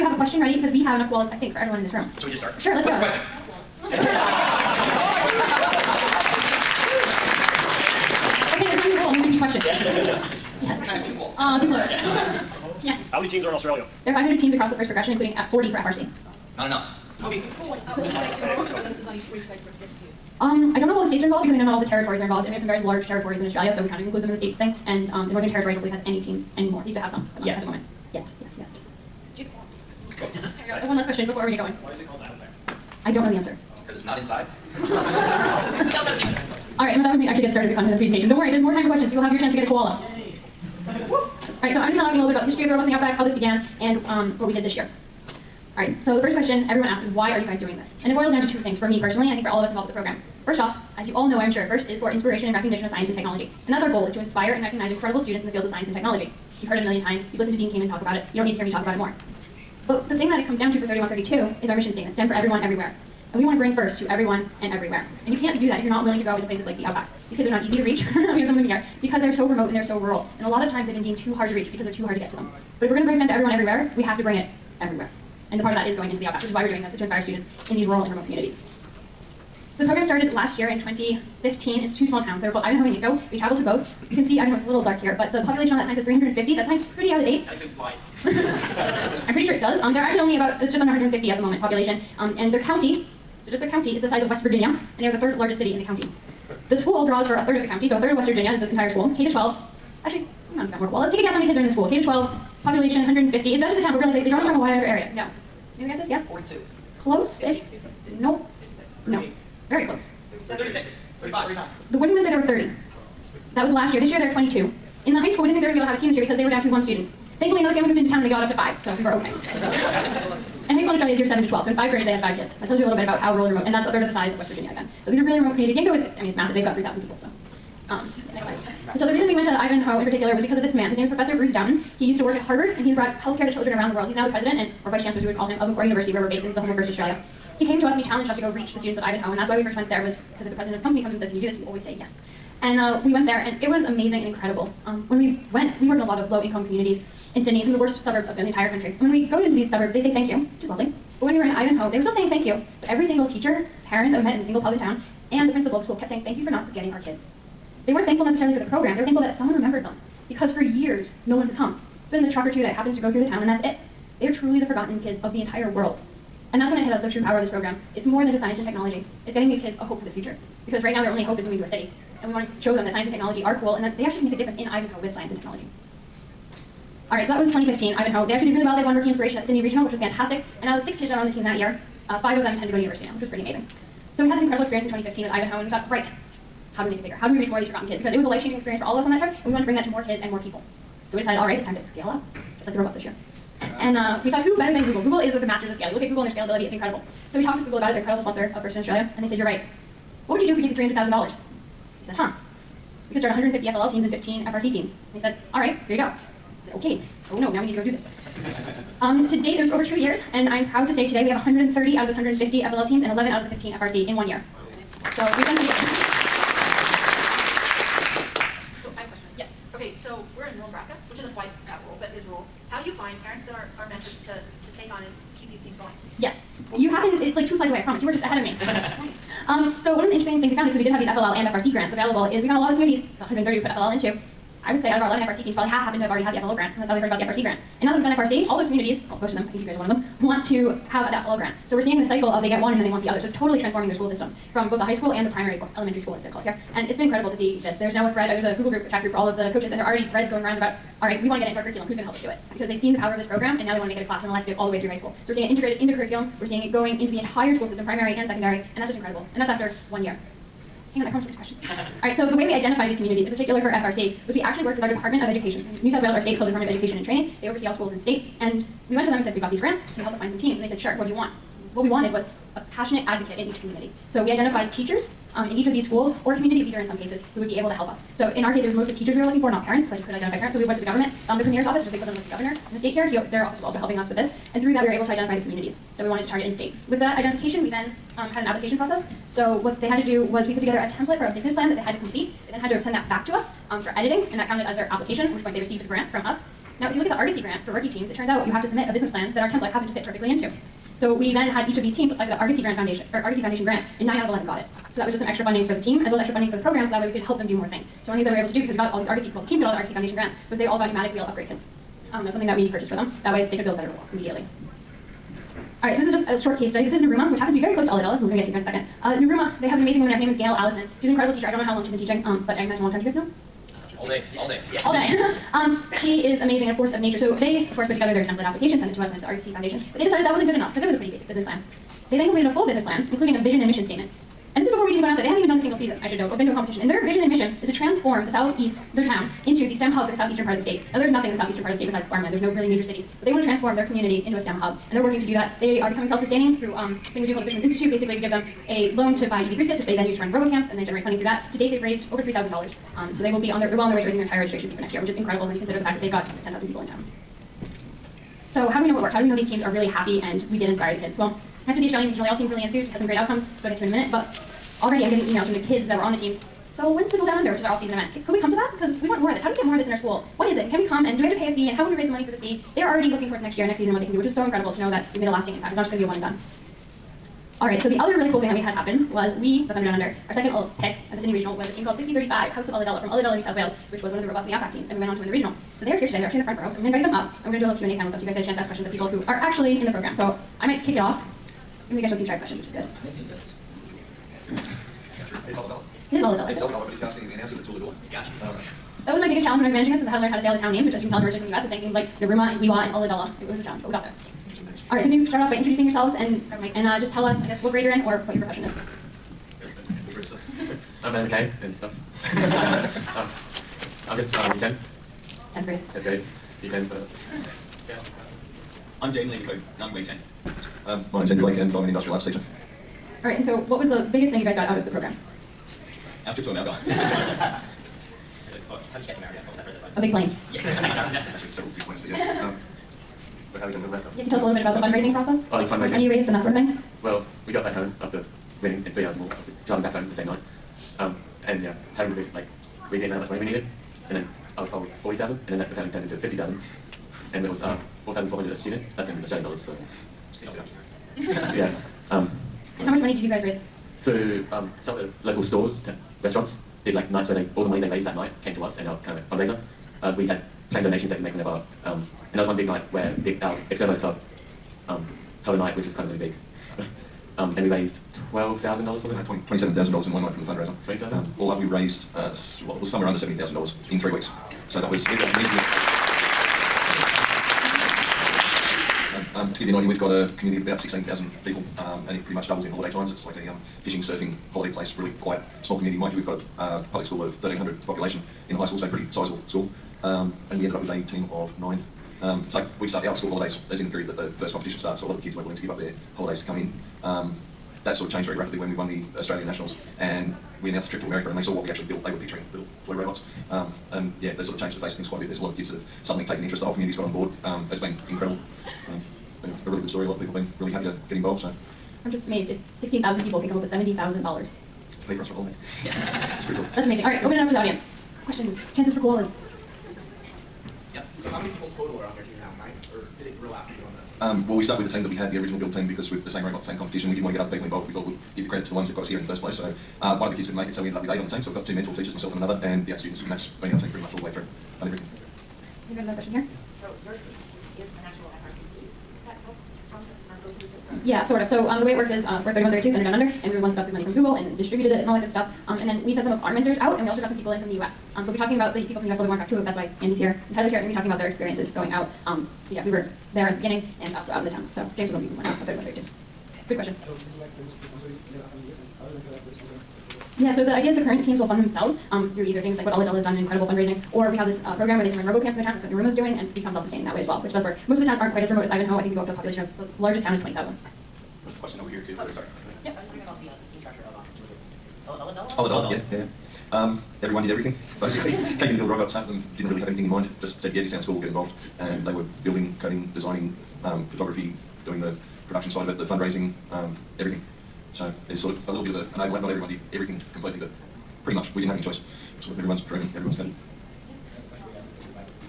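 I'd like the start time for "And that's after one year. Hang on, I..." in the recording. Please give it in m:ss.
4:19.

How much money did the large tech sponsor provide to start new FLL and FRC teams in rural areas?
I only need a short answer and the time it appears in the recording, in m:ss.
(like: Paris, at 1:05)
$300,000, at 3:20.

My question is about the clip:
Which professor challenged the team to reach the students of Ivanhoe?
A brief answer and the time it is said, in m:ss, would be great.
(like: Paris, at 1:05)
Bruce Dowton, at 2:11.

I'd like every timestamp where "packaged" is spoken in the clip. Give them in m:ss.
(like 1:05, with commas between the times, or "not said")
not said.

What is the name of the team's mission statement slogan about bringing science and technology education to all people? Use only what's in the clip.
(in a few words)
STEM for everyone, everywhere.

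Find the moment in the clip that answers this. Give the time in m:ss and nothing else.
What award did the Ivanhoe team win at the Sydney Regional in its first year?
2:58.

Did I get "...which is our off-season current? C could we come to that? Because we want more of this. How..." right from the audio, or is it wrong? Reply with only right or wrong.
wrong.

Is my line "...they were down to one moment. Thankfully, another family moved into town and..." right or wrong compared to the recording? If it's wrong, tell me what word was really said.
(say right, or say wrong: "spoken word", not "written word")
wrong: "student", not "moment".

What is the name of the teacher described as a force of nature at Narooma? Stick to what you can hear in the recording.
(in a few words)
Gail Allison.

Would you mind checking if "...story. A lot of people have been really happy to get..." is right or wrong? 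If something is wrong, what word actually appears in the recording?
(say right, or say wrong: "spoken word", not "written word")
right.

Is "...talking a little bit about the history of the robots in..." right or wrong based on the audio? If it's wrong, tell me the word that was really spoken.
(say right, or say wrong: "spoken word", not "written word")
right.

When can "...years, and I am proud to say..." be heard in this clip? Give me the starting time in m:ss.
3:29.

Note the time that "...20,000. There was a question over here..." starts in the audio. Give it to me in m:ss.
9:30.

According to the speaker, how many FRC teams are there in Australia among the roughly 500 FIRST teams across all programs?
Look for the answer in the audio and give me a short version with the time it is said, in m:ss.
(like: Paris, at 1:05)
40, at 0:15.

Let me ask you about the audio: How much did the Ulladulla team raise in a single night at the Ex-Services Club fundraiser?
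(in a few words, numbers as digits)
$27,000.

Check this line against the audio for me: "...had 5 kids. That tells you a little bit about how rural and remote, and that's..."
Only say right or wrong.
right.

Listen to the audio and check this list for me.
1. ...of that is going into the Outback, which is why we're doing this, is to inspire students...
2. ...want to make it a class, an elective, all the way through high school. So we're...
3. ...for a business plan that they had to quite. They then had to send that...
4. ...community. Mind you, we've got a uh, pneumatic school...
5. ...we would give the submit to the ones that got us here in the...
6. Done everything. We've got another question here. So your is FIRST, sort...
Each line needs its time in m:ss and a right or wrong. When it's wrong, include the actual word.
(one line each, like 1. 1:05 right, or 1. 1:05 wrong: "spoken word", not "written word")
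1. 1:15 right
2. 4:13 right
3. 4:51 wrong: "complete", not "quite"
4. 8:05 wrong: "public", not "pneumatic"
5. 8:48 wrong: "credit", not "submit"
6. 8:54 wrong: "Yeah", not "FIRST".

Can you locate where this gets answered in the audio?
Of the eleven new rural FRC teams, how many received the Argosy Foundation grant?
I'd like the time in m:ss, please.
5:04.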